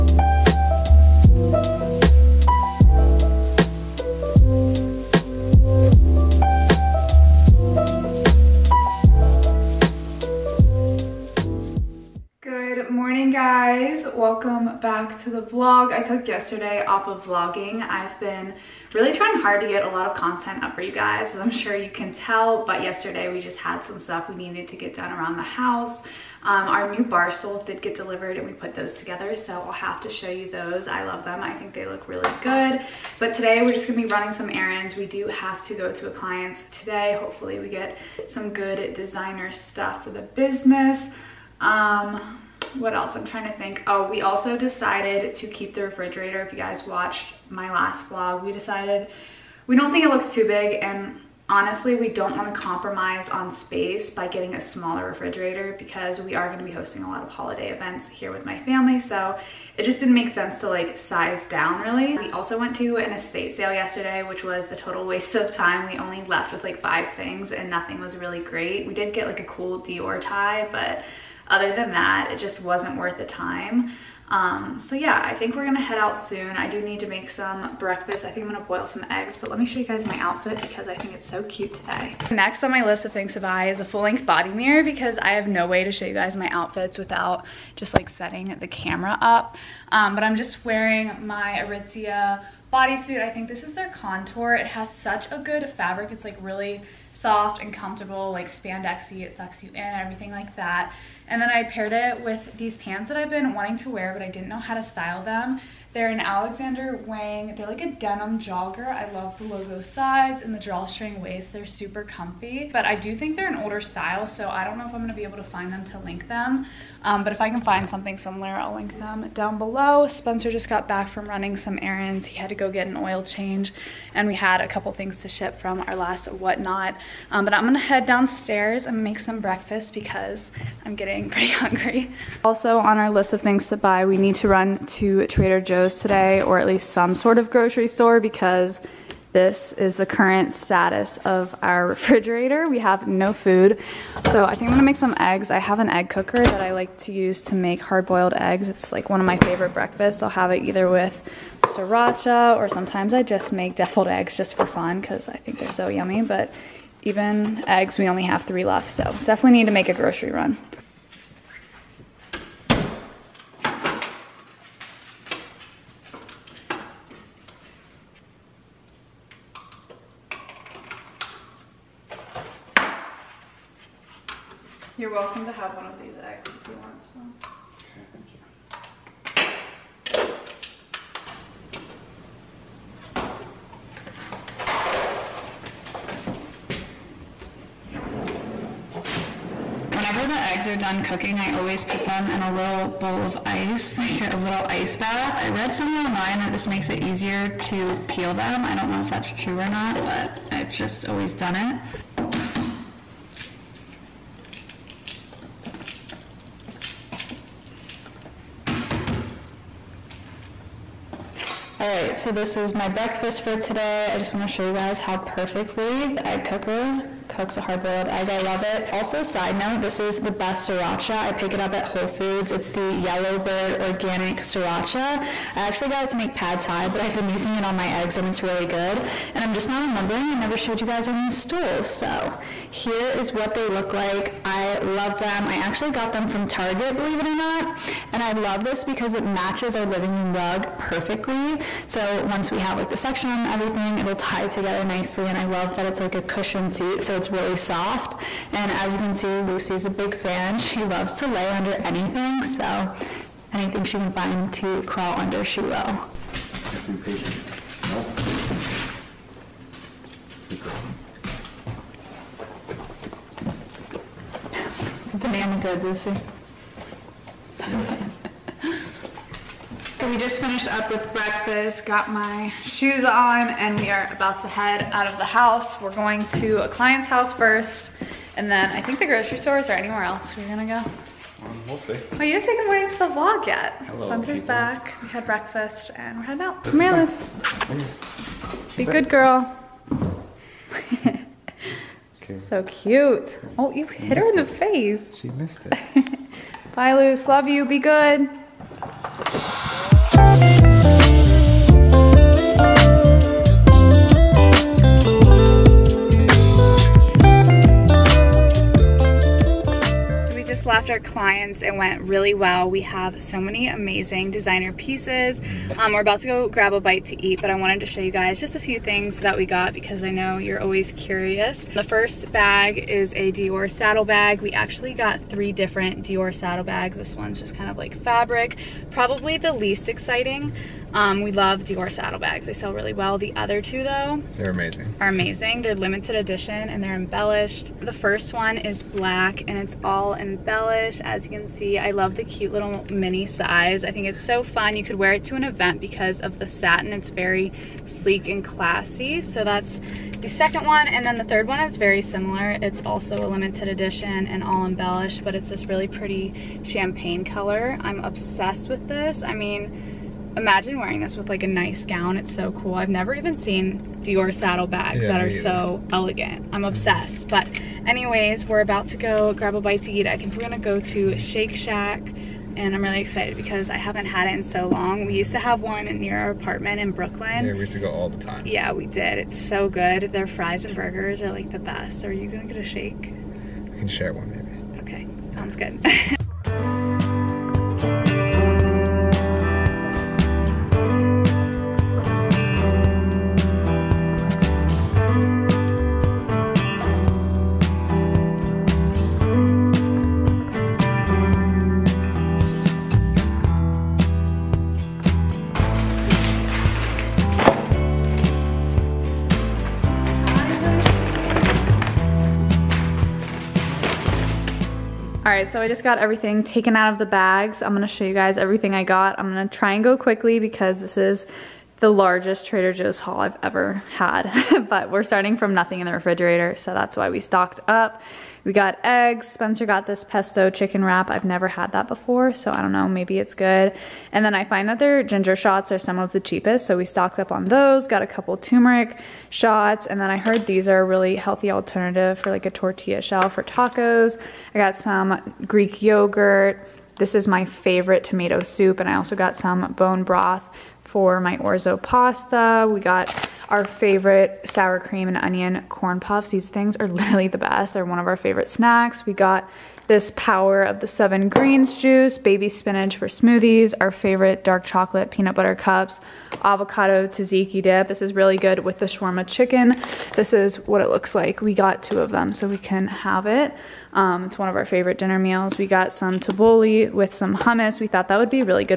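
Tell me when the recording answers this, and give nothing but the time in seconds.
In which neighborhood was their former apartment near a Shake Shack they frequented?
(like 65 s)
376 s.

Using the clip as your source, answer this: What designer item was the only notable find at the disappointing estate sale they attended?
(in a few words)
Dior tie.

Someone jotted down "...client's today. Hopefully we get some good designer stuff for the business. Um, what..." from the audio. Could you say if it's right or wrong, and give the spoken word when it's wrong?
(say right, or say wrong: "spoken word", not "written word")
right.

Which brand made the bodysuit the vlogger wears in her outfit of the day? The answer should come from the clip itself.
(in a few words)
Aritzia.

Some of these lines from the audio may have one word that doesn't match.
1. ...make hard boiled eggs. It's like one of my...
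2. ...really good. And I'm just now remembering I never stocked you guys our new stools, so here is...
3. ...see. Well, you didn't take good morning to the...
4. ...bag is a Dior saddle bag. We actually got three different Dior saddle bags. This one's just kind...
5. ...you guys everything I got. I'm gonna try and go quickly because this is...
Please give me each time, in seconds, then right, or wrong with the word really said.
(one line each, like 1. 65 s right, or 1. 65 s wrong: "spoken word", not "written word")
1. 147 s right
2. 228 s wrong: "showed", not "stocked"
3. 281 s right
4. 322 s right
5. 418 s right.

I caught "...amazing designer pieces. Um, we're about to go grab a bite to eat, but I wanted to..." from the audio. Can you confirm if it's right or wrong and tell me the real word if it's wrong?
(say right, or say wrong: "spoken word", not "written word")
right.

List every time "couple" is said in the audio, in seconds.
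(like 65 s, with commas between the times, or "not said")
124 s, 438 s.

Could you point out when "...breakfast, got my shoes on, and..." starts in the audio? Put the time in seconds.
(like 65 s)
271 s.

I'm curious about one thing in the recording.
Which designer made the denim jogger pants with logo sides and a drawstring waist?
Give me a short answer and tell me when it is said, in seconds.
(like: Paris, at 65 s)
Alexander Wang, at 106 s.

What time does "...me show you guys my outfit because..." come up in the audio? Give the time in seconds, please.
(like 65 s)
79 s.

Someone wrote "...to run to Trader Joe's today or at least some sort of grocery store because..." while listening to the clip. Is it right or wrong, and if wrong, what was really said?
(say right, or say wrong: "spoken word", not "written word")
right.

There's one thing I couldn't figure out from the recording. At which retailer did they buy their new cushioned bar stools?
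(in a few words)
Target.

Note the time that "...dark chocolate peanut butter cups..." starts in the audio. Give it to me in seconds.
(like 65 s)
464 s.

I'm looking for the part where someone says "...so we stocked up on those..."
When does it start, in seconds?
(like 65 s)
436 s.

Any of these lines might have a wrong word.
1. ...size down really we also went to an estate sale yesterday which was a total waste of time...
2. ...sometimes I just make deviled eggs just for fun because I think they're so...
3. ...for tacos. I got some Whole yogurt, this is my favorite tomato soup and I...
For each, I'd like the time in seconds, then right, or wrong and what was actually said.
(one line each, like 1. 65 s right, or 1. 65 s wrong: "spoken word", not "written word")
1. 60 s right
2. 152 s right
3. 443 s wrong: "Greek", not "Whole".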